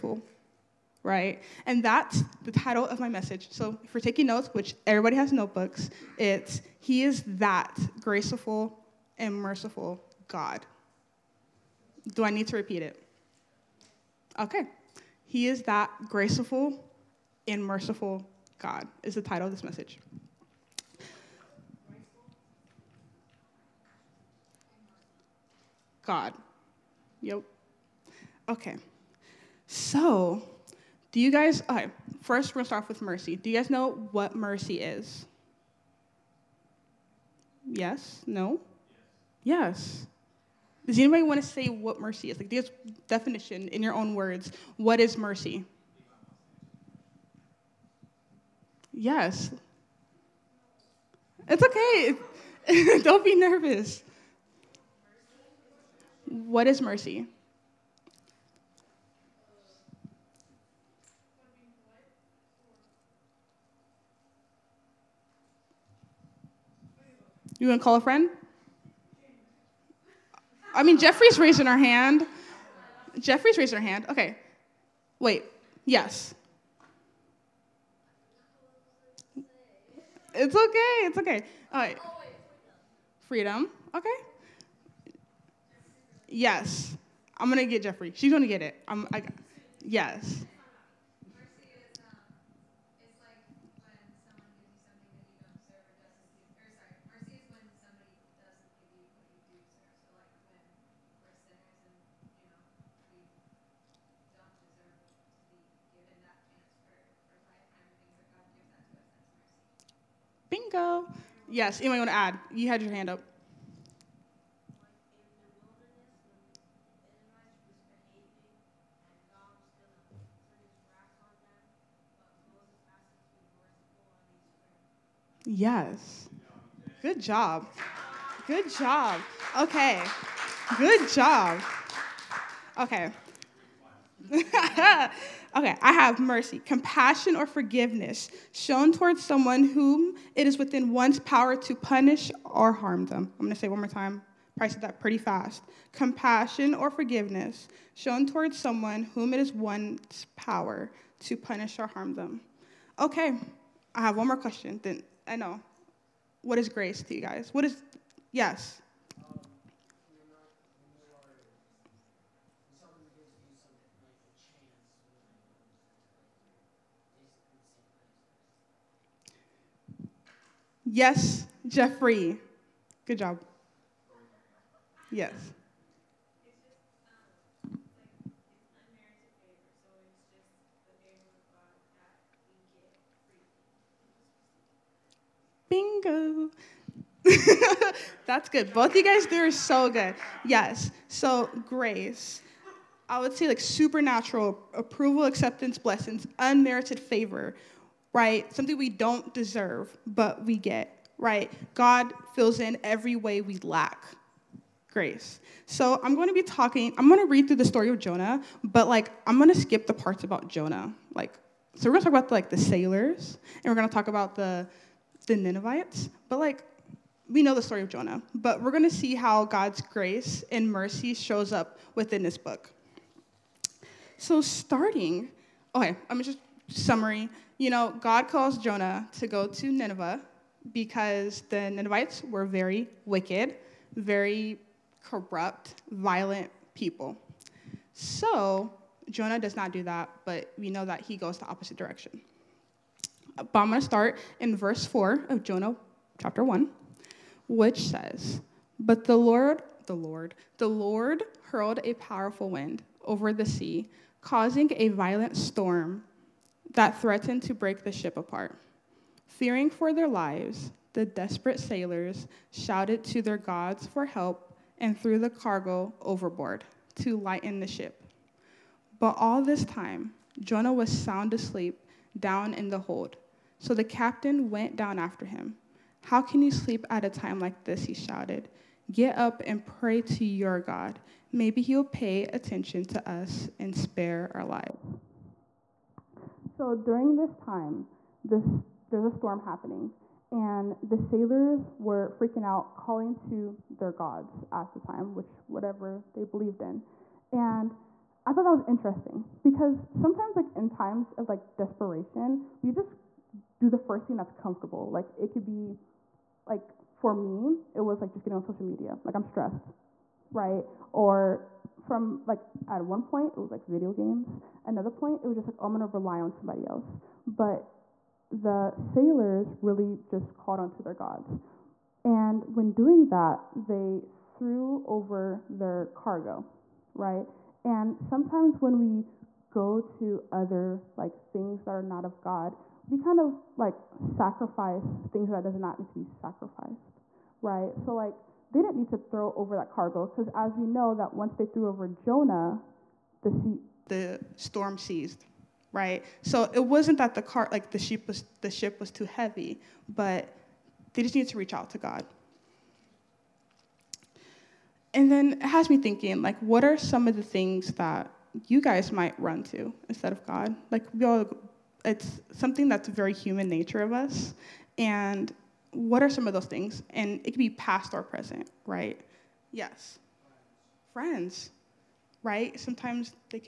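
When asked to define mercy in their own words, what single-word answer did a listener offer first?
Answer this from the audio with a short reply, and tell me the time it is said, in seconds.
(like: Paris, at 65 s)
Freedom, at 83 s.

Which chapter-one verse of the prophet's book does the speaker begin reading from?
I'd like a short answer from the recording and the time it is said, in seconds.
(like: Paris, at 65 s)
Verse 4, at 244 s.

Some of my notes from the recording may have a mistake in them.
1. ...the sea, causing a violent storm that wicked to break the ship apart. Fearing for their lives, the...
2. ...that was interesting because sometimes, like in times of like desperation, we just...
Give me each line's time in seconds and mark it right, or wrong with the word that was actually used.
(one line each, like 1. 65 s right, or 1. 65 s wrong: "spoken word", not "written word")
1. 253 s wrong: "threatened", not "wicked"
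2. 298 s right.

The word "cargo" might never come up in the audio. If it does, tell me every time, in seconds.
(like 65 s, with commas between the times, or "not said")
265 s, 325 s, 339 s.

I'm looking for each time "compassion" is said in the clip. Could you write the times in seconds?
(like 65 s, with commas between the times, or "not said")
136 s, 145 s.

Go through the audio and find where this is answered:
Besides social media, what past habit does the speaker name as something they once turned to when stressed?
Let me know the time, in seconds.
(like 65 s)
313 s.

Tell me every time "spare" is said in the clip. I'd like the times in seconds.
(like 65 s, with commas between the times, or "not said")
283 s.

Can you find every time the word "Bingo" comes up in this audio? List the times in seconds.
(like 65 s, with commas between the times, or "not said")
110 s, 185 s.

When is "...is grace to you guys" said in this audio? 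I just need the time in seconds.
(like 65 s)
156 s.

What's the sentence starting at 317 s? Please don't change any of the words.
But the sailors really just on onto their gods.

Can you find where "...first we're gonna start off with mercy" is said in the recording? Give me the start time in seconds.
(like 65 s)
32 s.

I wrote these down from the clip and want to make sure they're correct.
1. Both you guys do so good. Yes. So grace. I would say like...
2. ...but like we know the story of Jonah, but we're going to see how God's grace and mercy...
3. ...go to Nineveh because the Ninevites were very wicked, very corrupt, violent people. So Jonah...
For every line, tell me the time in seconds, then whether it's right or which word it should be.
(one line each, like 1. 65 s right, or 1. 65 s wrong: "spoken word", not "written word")
1. 188 s right
2. 216 s right
3. 229 s right.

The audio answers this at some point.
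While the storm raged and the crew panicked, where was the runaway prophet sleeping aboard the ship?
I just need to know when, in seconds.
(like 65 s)
272 s.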